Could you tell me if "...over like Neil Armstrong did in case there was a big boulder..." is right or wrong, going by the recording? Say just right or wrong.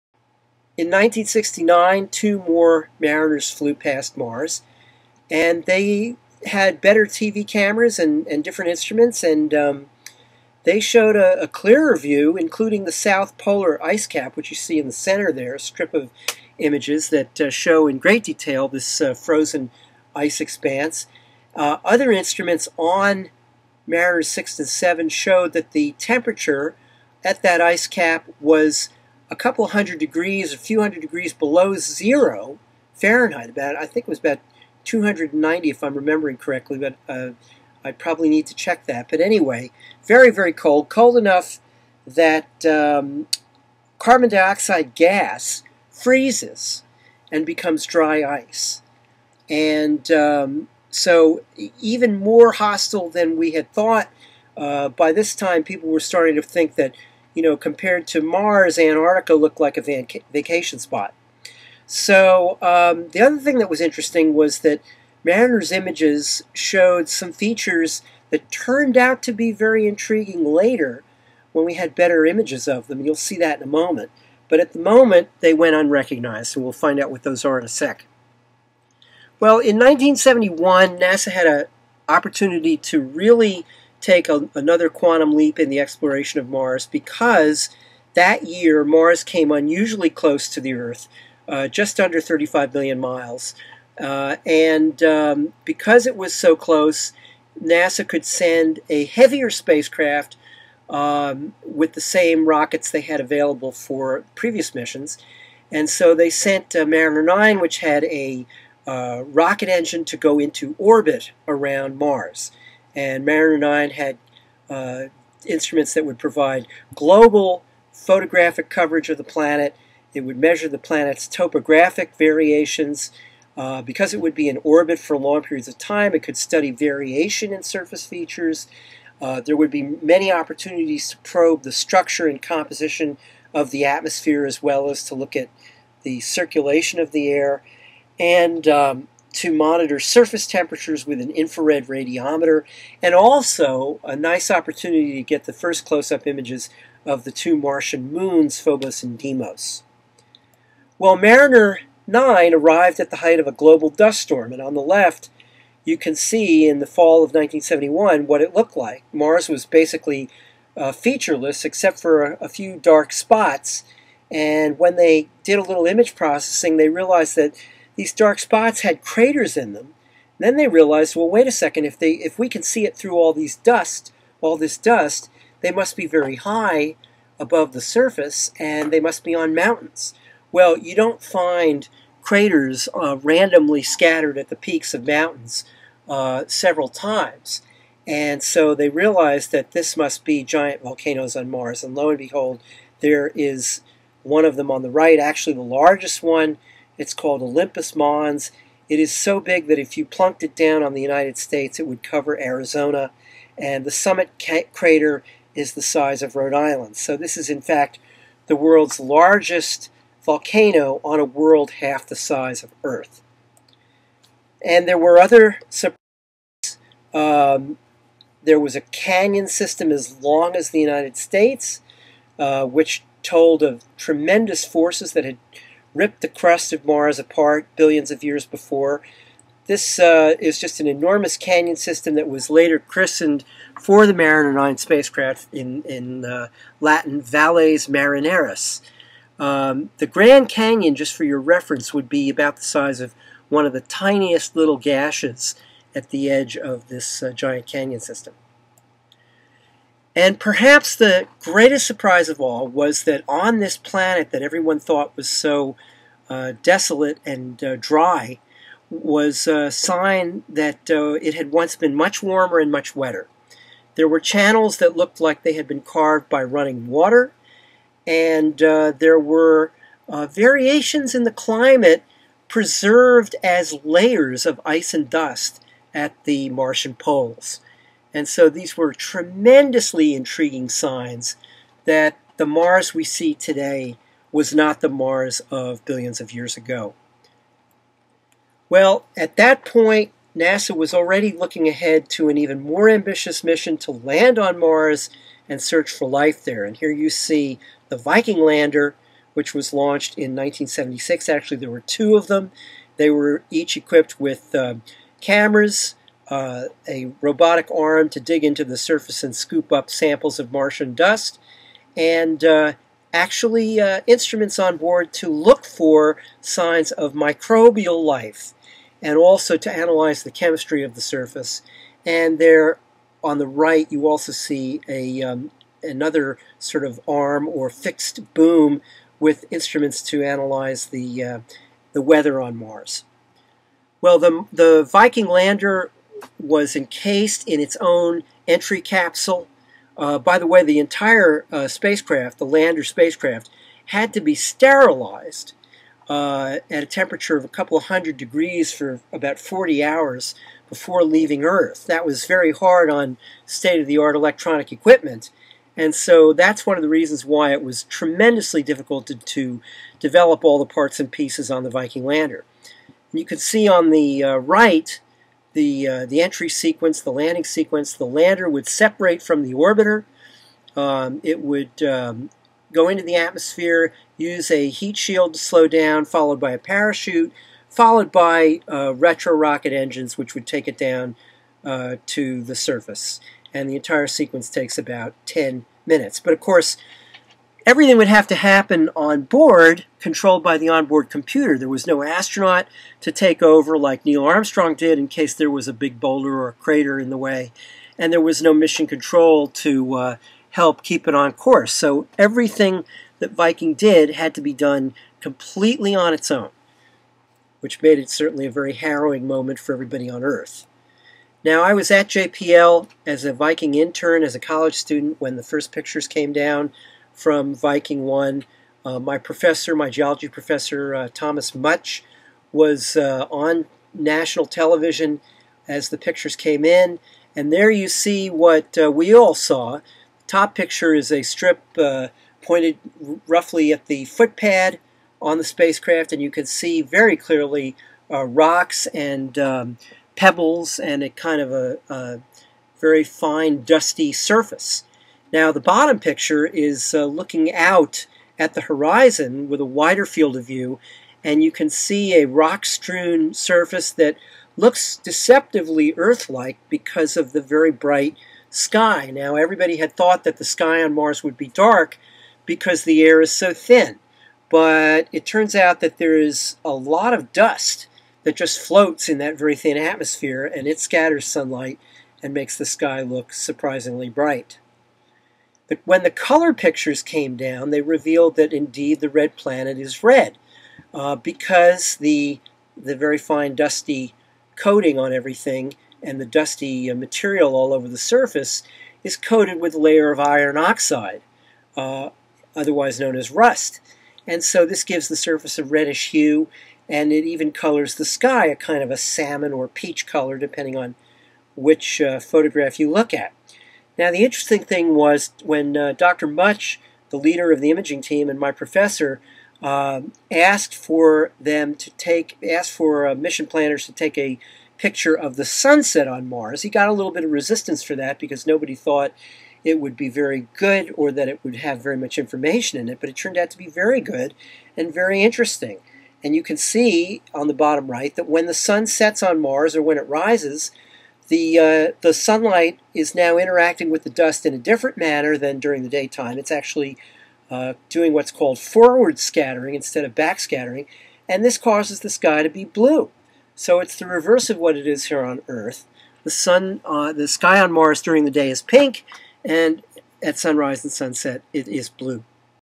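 right.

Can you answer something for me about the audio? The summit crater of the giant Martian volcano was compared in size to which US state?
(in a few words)
Rhode Island.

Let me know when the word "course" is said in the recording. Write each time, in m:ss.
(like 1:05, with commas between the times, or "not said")
6:26, 6:41.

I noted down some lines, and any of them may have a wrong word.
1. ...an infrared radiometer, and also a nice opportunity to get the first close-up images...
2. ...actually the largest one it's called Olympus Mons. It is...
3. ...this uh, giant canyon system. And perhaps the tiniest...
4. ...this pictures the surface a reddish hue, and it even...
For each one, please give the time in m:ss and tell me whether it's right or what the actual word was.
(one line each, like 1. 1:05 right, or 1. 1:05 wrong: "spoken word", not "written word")
1. 2:21 right
2. 3:15 right
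3. 4:06 wrong: "greatest", not "tiniest"
4. 8:14 wrong: "gives", not "pictures".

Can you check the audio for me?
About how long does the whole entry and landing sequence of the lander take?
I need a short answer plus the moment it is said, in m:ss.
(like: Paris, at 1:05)
10 minutes, at 6:25.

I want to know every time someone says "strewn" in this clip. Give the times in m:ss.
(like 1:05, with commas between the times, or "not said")
7:32.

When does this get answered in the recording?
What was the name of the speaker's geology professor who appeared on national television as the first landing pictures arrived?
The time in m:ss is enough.
7:01.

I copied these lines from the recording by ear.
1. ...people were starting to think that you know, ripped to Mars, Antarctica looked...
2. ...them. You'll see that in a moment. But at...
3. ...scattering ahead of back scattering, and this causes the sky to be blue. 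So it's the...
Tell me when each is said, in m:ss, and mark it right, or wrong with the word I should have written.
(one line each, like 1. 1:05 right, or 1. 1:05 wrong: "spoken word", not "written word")
1. 0:55 wrong: "compared", not "ripped"
2. 1:12 right
3. 8:59 wrong: "instead", not "ahead".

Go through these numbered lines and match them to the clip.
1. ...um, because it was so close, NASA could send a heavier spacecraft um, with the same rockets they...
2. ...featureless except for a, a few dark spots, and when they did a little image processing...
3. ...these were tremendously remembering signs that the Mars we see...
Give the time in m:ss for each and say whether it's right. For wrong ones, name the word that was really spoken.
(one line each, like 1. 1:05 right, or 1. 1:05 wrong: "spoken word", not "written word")
1. 1:35 right
2. 2:40 right
3. 4:38 wrong: "intriguing", not "remembering".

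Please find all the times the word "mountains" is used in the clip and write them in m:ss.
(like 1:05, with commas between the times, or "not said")
2:59, 3:05.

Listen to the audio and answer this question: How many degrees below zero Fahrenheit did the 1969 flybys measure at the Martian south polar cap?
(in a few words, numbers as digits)
290.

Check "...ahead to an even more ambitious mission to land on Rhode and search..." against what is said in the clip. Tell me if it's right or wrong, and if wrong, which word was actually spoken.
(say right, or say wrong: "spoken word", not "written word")
wrong: "Mars", not "Rhode".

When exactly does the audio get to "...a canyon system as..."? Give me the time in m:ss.
3:38.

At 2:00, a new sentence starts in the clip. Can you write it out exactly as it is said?
It would measure the planet's topographic variations.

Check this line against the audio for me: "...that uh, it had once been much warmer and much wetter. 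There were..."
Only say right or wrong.
right.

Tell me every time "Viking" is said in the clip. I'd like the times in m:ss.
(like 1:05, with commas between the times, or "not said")
4:57, 5:34, 6:01, 6:43, 6:53, 6:57.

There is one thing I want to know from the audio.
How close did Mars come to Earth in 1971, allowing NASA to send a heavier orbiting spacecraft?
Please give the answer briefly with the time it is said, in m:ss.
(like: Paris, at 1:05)
just under 35 million miles, at 1:31.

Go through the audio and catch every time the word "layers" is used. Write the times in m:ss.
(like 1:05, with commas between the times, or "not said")
4:33, 8:09.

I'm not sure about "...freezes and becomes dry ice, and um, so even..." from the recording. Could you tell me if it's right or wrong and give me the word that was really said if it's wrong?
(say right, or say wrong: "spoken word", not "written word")
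right.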